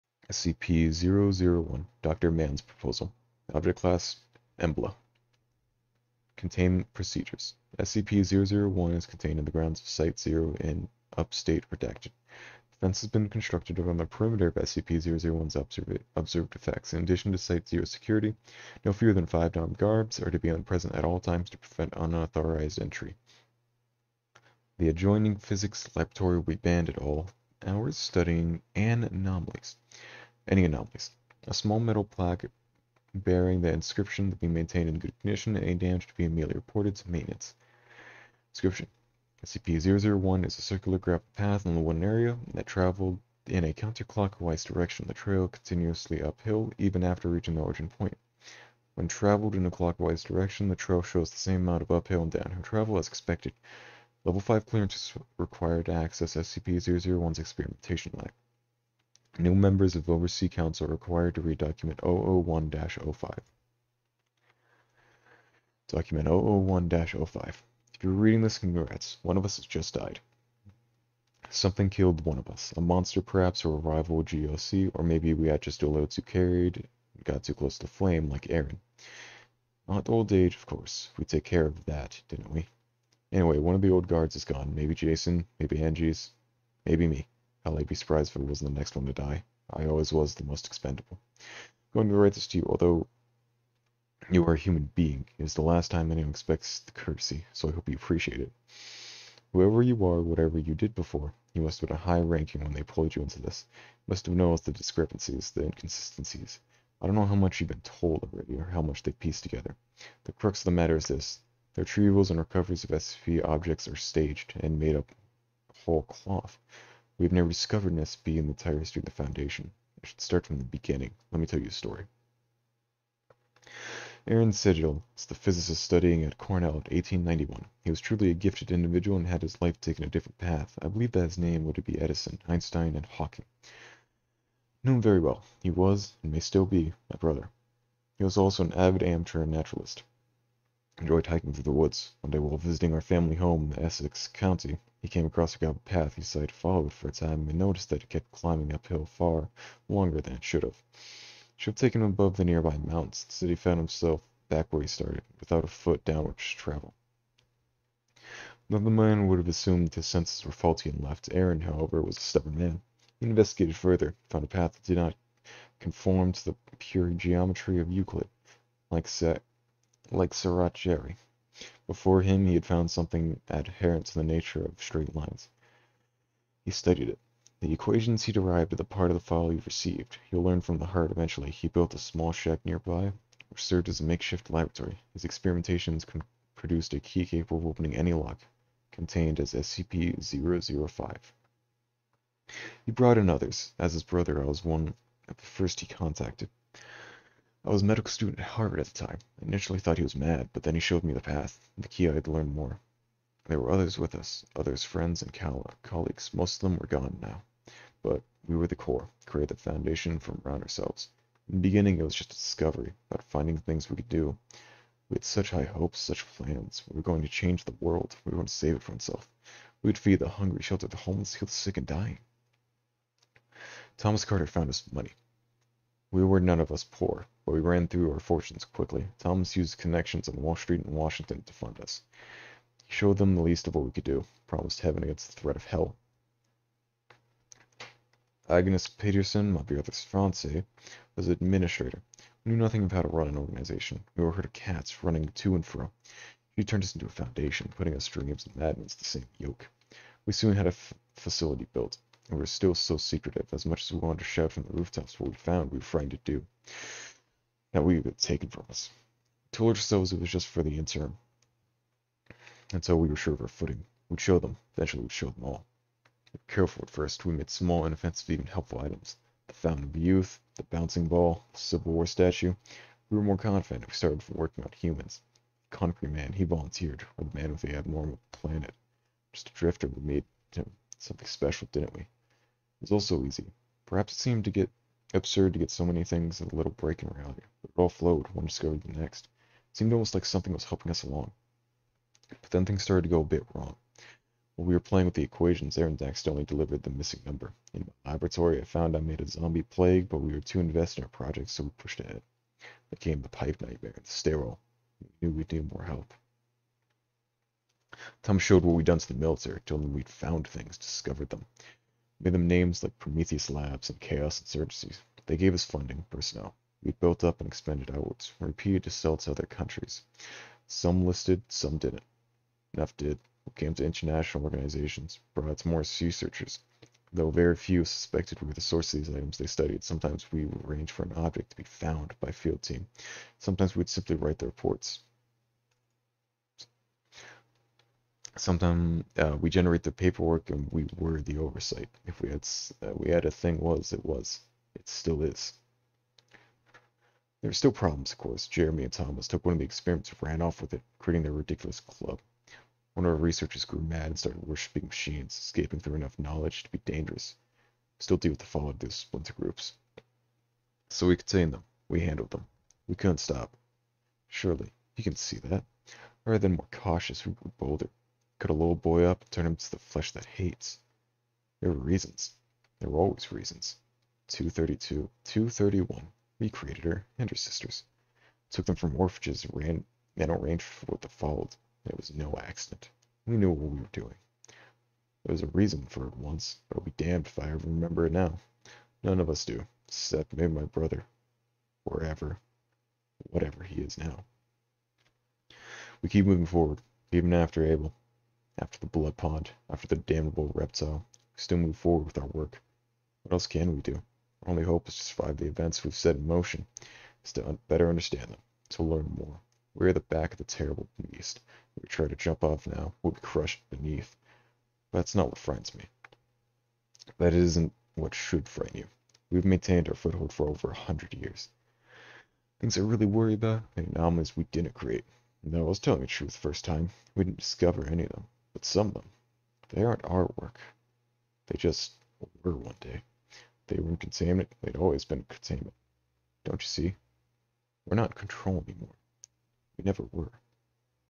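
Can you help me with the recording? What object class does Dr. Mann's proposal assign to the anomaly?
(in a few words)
Embla.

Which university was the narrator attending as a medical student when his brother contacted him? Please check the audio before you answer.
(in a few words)
Harvard.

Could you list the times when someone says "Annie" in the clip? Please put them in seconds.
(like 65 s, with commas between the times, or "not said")
not said.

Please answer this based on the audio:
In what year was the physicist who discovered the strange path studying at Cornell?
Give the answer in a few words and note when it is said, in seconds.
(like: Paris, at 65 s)
1891, at 126 s.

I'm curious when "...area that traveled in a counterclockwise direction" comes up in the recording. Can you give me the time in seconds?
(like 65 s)
42 s.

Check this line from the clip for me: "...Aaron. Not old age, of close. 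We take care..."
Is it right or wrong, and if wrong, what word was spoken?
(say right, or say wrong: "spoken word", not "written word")
wrong: "course", not "close".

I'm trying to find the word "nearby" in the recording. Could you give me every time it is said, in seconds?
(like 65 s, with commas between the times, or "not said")
152 s, 182 s.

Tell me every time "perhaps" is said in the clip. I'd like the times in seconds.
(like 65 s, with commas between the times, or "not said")
73 s, 283 s.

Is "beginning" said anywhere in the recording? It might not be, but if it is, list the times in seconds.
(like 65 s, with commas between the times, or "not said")
120 s, 211 s.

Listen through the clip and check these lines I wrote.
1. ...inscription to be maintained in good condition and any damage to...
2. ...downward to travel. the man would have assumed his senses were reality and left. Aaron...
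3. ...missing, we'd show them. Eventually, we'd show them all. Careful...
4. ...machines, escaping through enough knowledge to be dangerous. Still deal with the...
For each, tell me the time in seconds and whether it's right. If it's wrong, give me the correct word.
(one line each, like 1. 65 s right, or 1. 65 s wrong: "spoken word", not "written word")
1. 33 s right
2. 156 s wrong: "faulty", not "reality"
3. 263 s wrong: "footing", not "missing"
4. 354 s right.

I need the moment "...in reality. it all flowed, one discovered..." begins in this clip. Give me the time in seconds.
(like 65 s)
287 s.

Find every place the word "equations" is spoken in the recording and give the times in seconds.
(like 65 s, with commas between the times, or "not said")
177 s, 295 s.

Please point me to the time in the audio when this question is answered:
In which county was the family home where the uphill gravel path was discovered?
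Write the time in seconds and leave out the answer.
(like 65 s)
143 s.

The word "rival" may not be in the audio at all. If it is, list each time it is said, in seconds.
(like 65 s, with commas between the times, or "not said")
73 s.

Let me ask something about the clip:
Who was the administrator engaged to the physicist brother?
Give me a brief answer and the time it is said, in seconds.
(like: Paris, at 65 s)
Agnes Peterson, at 238 s.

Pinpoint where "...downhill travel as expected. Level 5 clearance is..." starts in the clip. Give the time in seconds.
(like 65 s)
52 s.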